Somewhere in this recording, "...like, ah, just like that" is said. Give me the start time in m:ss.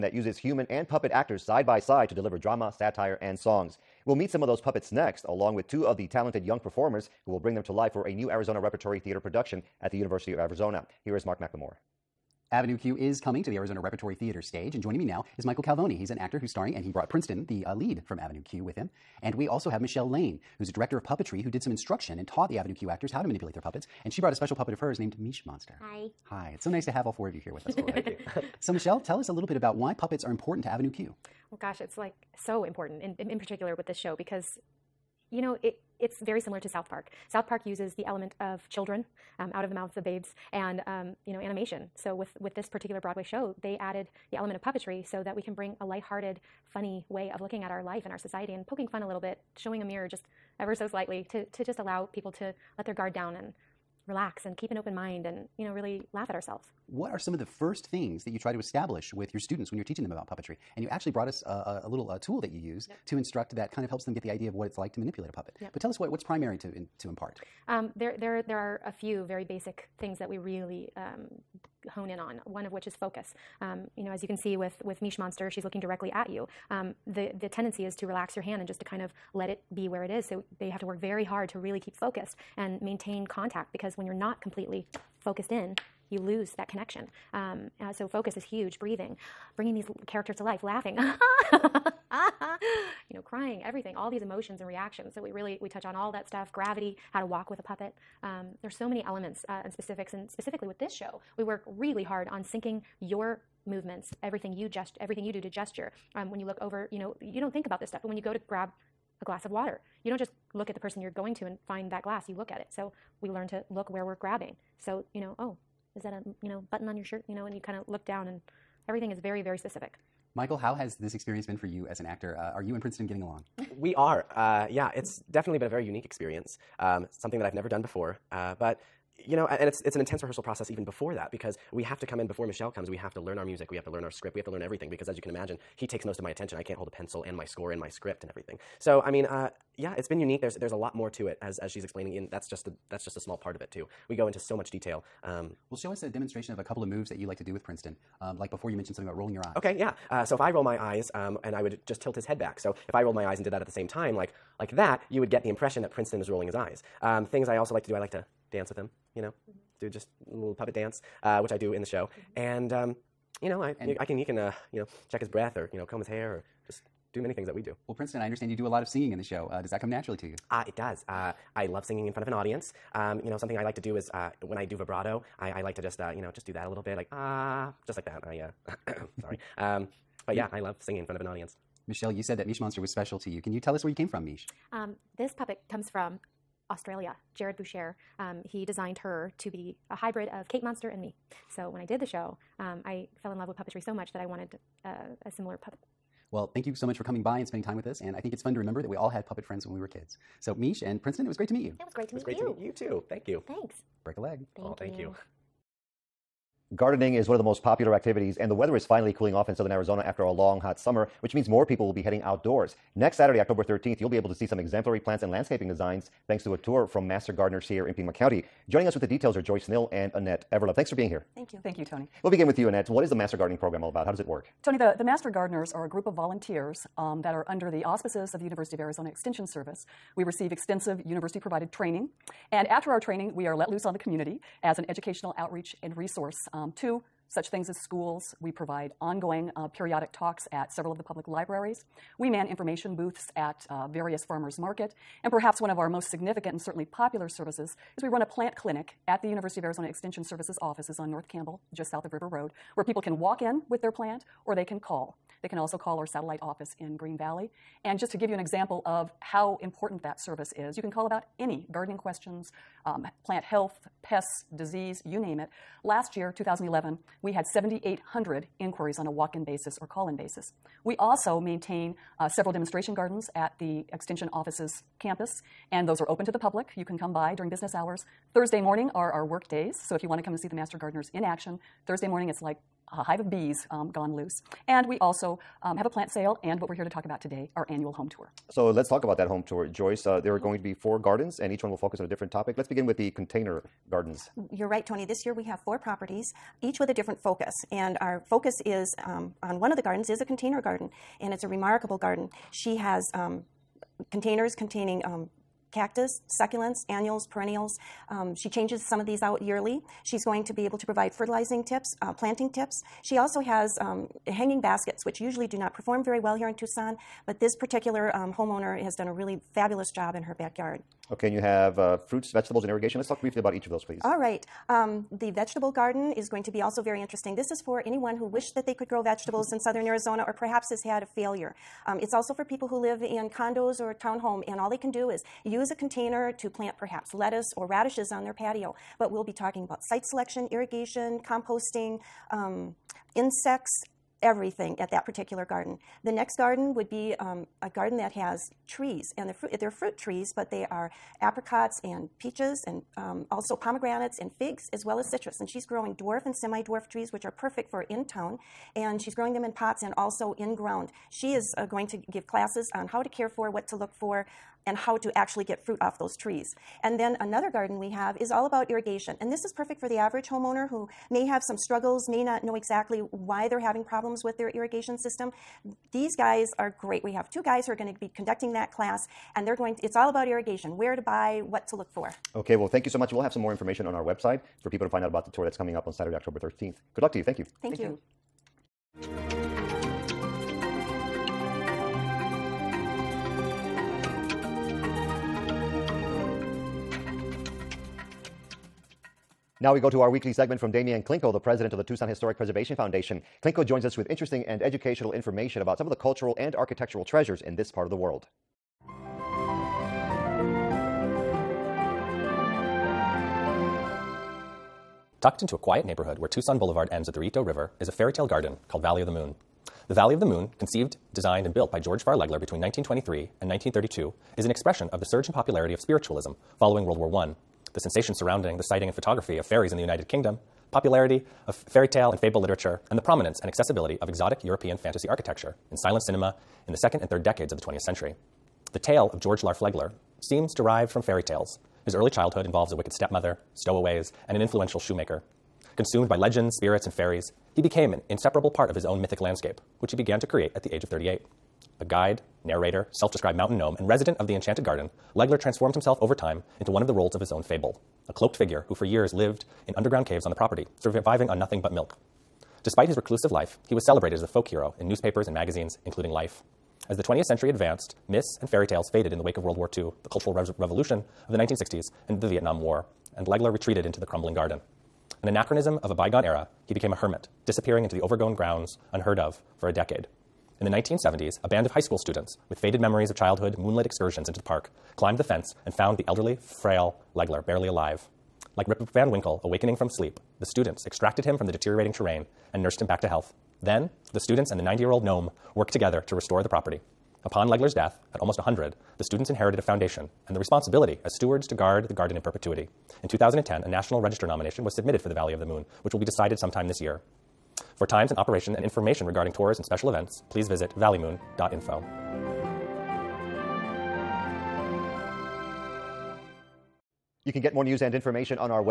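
2:56.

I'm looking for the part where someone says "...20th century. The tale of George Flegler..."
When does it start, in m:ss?
7:17.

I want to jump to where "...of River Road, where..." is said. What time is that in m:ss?
4:12.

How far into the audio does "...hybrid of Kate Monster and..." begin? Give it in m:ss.
3:09.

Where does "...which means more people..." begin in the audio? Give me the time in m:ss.
3:31.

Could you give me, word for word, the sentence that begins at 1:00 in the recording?
And you actually brought us a, a, a little tool that you use yep.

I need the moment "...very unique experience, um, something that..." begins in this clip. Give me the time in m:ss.
2:05.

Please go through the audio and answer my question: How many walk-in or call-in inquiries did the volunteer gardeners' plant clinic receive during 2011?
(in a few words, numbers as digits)
7,800.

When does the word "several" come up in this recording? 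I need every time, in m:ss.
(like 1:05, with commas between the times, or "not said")
4:00, 4:32.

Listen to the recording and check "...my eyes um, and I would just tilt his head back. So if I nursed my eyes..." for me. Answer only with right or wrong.
wrong.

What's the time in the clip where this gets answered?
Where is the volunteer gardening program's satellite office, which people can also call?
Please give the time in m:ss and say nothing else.
4:16.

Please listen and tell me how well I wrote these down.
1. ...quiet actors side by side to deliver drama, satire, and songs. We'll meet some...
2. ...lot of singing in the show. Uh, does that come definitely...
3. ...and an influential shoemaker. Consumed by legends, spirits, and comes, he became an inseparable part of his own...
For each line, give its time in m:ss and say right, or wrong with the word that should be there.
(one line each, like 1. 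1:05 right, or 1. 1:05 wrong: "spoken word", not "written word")
1. 0:00 wrong: "puppet", not "quiet"
2. 2:48 wrong: "naturally", not "definitely"
3. 7:24 wrong: "fairies", not "comes".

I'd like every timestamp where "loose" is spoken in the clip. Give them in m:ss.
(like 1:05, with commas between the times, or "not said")
3:53, 4:44.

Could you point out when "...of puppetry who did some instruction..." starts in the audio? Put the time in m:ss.
0:20.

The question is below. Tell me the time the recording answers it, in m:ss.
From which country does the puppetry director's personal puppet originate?
3:06.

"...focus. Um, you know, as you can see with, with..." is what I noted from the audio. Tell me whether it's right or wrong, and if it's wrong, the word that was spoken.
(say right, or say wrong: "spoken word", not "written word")
right.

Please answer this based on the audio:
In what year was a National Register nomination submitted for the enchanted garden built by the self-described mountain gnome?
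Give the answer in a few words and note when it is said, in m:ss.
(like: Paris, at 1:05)
2010, at 8:23.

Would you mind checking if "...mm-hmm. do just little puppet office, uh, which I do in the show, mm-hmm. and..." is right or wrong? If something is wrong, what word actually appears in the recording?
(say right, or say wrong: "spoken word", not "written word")
wrong: "dance", not "office".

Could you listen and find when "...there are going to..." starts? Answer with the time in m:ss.
4:50.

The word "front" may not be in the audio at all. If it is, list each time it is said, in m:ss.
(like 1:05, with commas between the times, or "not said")
2:52, 3:01.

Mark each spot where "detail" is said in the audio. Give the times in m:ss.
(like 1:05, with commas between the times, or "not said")
2:24, 3:39.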